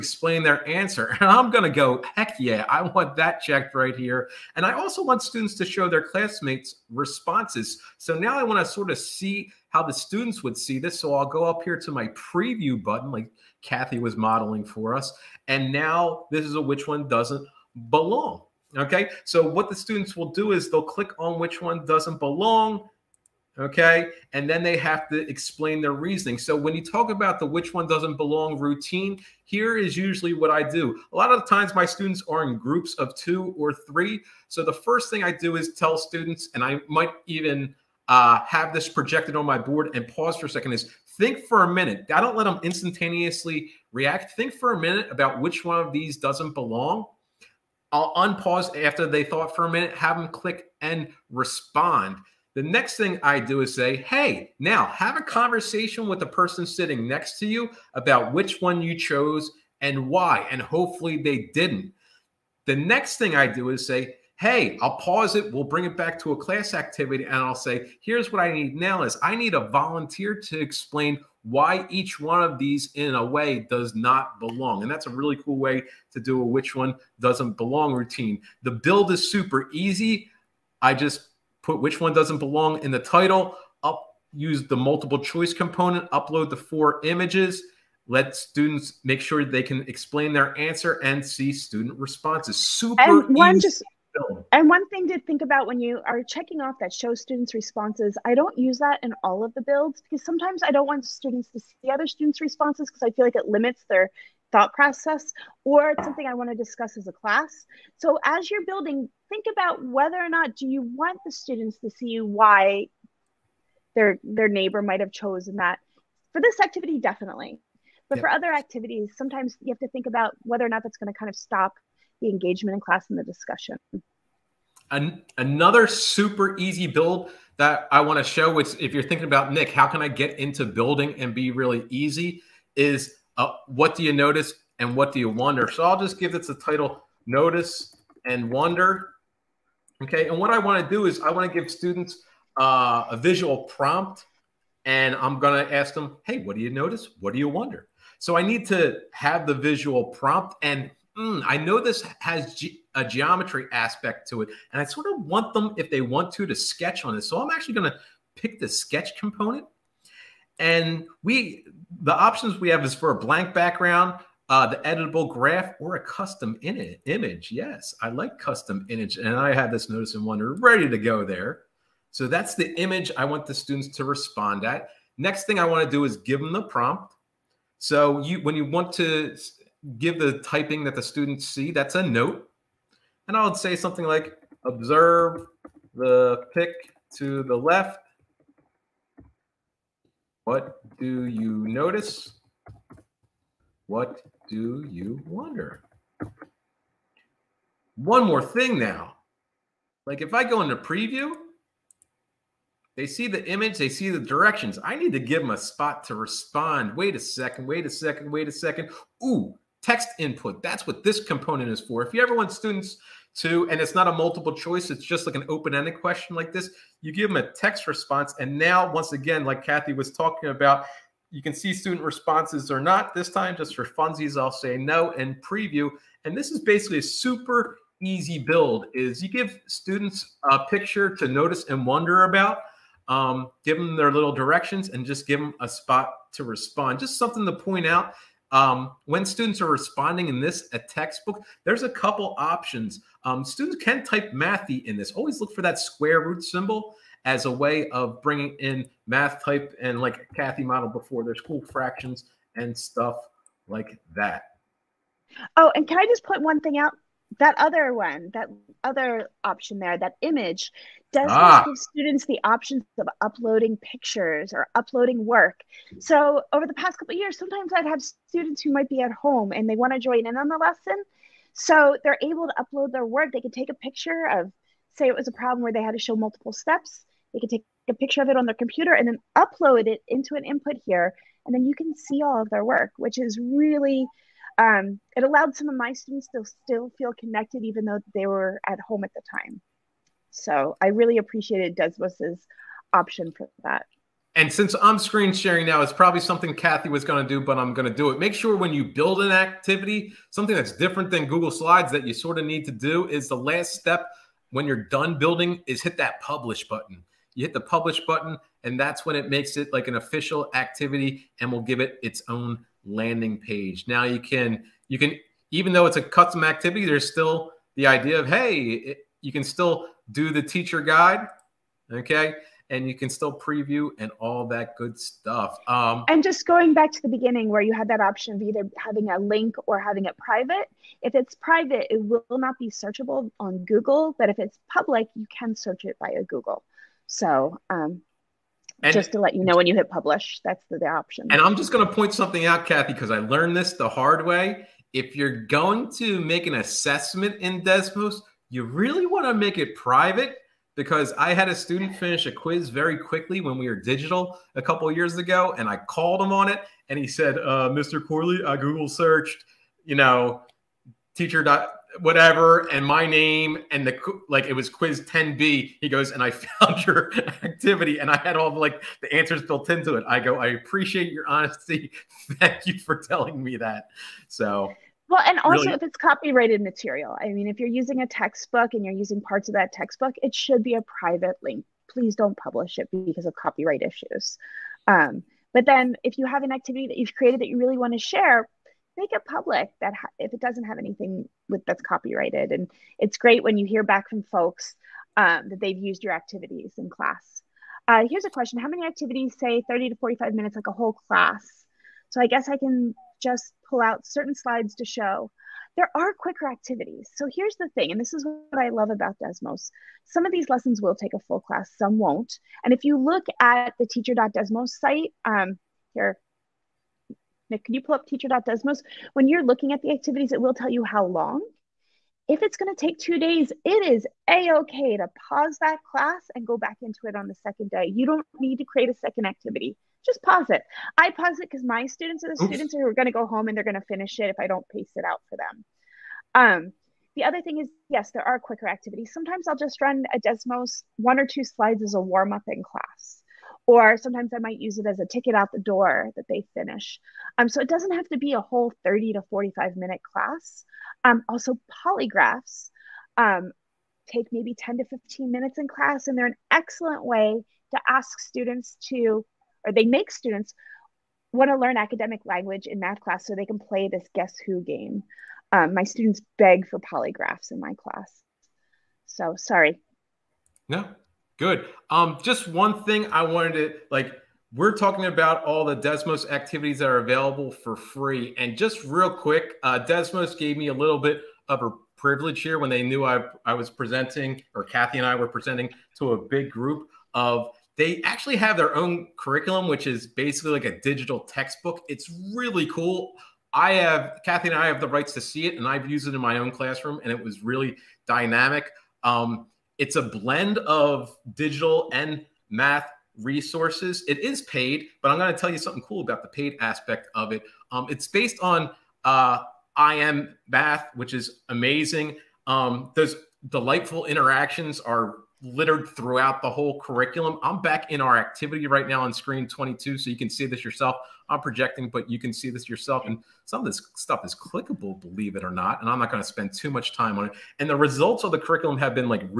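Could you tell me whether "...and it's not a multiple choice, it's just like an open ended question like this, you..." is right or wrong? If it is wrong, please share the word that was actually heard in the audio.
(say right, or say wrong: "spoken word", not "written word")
right.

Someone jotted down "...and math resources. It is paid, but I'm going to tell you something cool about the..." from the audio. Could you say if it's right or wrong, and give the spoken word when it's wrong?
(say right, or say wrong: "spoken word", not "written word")
right.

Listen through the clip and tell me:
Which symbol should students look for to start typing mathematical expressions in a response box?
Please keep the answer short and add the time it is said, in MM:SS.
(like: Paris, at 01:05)
square root symbol, at 04:05.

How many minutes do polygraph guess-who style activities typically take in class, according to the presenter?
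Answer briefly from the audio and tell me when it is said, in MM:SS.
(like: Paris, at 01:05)
10 to 15, at 07:34.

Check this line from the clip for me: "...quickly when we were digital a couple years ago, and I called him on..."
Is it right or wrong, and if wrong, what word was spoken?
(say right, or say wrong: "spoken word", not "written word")
right.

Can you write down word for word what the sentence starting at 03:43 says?
This time, just for funsies, I'll say no and preview.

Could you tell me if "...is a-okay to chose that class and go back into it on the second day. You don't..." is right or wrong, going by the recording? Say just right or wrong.
wrong.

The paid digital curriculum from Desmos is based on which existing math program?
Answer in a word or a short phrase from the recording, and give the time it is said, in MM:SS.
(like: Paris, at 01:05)
IM Math, at 08:29.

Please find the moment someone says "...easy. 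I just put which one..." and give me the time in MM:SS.
01:19.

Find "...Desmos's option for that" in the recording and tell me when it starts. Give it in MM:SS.
04:51.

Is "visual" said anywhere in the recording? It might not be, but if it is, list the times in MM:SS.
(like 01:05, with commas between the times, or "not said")
02:23, 02:29.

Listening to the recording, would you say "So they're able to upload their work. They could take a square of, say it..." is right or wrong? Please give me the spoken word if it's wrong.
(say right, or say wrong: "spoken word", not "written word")
wrong: "picture", not "square".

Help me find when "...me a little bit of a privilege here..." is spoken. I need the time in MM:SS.
08:00.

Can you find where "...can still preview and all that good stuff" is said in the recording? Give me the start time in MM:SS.
05:22.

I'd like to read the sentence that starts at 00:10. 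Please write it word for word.
So I'll go up here to my preview button, like Kathy was modeling for us.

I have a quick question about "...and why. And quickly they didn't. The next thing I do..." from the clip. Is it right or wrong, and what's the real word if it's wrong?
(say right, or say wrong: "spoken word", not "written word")
wrong: "hopefully", not "quickly".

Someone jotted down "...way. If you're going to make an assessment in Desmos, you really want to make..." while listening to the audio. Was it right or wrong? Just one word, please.
right.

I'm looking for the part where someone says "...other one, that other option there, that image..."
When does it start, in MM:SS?
04:17.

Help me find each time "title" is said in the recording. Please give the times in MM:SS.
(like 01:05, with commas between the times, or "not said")
01:22, 02:16.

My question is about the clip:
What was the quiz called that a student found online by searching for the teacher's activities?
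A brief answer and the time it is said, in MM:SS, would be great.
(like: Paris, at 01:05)
quiz 10b, at 06:04.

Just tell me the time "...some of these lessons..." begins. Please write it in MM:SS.
06:50.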